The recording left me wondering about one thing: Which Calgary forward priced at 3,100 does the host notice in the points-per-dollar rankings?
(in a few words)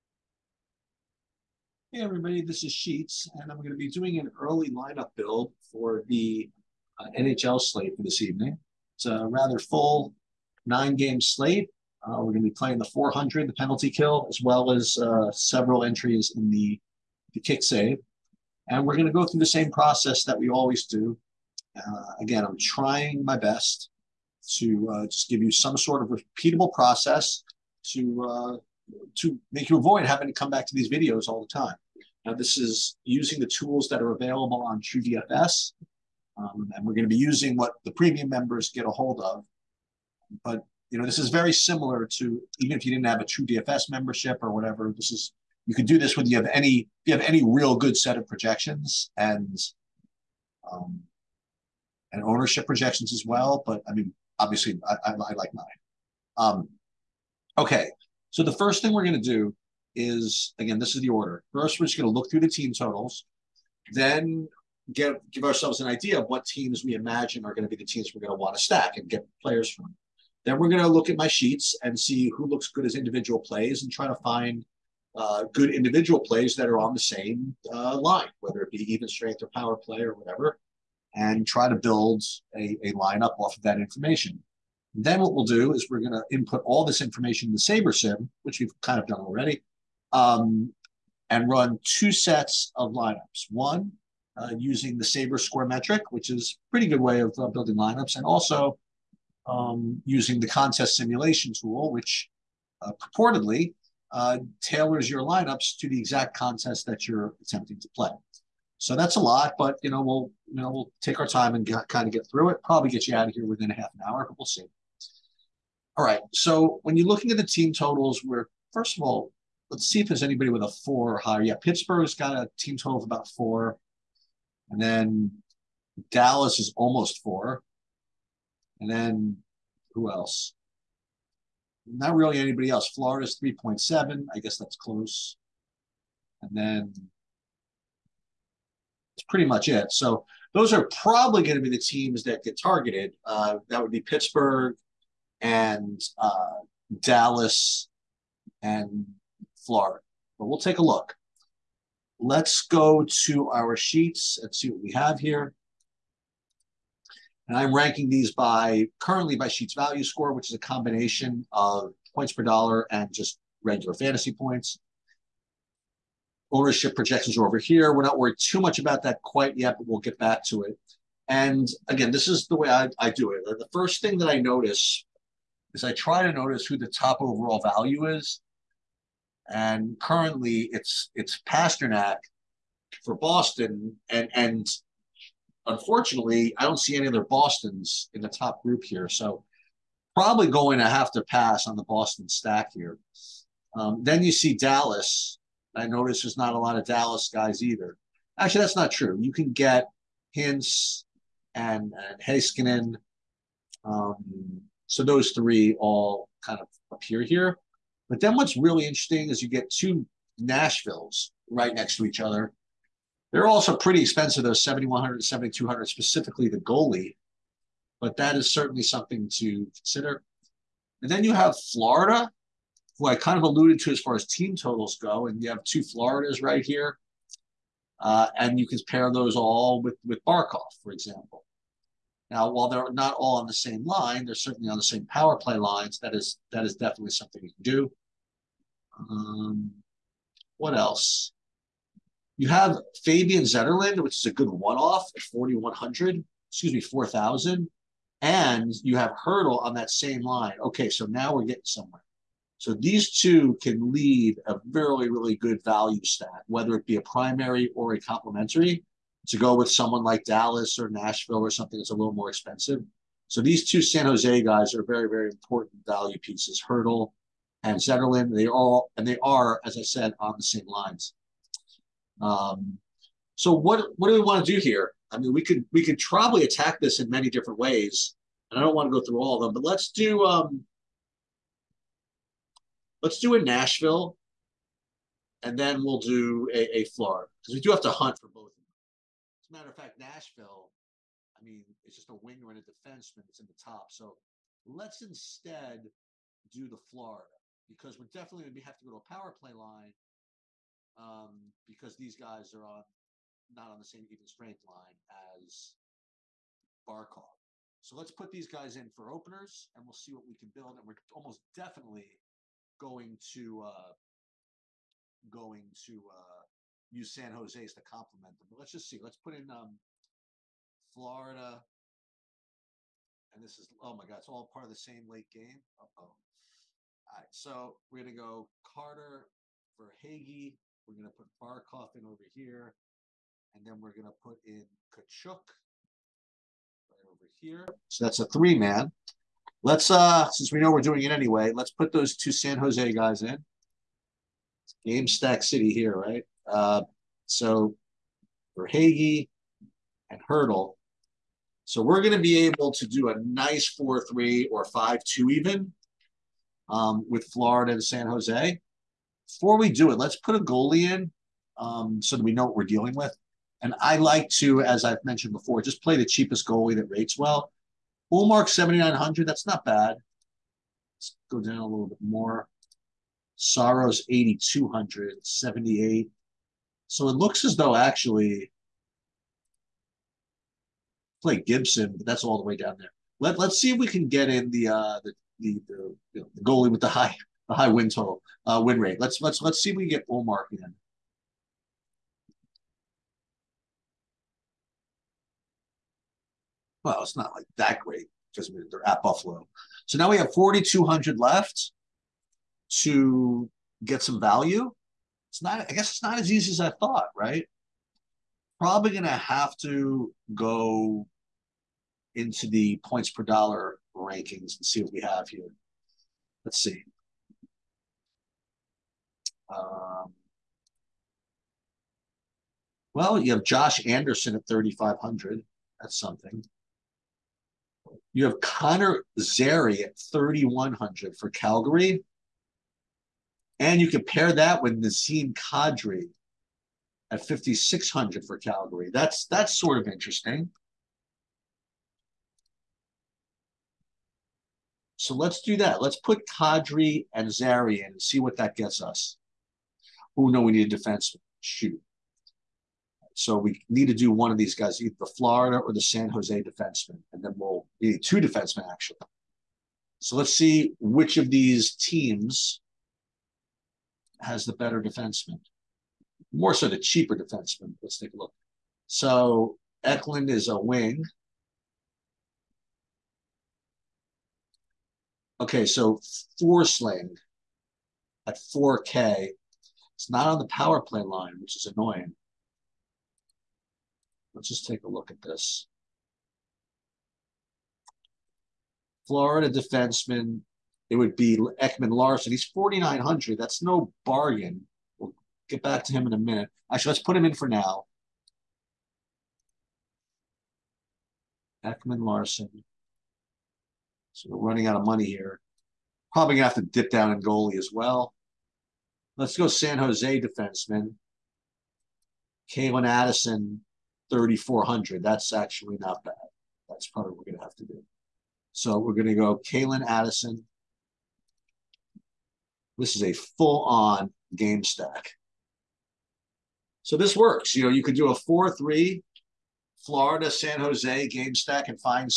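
Connor Zary.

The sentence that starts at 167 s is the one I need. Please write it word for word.
We're not worried too much about that quite yet, but we'll get back to it.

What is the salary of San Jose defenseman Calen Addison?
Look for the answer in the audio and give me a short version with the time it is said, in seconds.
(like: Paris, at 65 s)
3,400, at 514 s.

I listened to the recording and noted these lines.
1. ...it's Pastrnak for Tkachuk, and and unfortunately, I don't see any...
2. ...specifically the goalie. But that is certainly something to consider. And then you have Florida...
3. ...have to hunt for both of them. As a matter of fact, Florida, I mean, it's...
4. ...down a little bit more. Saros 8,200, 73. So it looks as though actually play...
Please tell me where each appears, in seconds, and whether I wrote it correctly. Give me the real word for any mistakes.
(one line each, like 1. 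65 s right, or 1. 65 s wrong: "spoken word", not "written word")
1. 181 s wrong: "Boston", not "Tkachuk"
2. 215 s right
3. 287 s wrong: "Nashville", not "Florida"
4. 371 s wrong: "78", not "73".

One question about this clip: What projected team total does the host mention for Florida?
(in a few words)
3.7.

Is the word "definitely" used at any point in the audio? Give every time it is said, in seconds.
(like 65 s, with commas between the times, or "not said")
236 s, 298 s, 311 s.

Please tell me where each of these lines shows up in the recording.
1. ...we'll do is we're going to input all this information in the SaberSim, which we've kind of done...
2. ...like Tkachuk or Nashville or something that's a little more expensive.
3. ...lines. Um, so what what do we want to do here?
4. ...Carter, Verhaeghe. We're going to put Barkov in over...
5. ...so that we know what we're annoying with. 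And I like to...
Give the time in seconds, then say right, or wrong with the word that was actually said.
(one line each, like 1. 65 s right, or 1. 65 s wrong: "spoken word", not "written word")
1. 85 s right
2. 260 s wrong: "Dallas", not "Tkachuk"
3. 270 s right
4. 328 s right
5. 362 s wrong: "dealing", not "annoying".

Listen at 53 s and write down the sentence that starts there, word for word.
But I mean, obviously, I, I, I like mine.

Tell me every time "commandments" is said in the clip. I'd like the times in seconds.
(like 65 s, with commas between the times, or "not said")
not said.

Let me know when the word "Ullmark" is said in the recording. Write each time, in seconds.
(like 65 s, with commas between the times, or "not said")
368 s, 390 s.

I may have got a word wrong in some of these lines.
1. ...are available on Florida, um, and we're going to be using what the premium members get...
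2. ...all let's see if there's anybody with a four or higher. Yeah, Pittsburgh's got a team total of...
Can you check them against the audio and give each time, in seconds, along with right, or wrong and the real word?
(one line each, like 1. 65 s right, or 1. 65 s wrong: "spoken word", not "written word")
1. 34 s wrong: "TrueDFS", not "Florida"
2. 119 s right.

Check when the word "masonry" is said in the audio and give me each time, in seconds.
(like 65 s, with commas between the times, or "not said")
not said.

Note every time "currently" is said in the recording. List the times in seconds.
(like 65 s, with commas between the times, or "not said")
158 s, 180 s.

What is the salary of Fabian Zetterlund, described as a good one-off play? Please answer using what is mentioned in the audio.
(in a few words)
4,000.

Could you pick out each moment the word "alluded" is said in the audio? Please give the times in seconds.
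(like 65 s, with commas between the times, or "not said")
223 s.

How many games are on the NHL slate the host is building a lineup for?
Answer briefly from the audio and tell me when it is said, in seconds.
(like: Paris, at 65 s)
9, at 10 s.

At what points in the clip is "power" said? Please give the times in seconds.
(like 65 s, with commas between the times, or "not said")
79 s, 235 s, 299 s, 480 s.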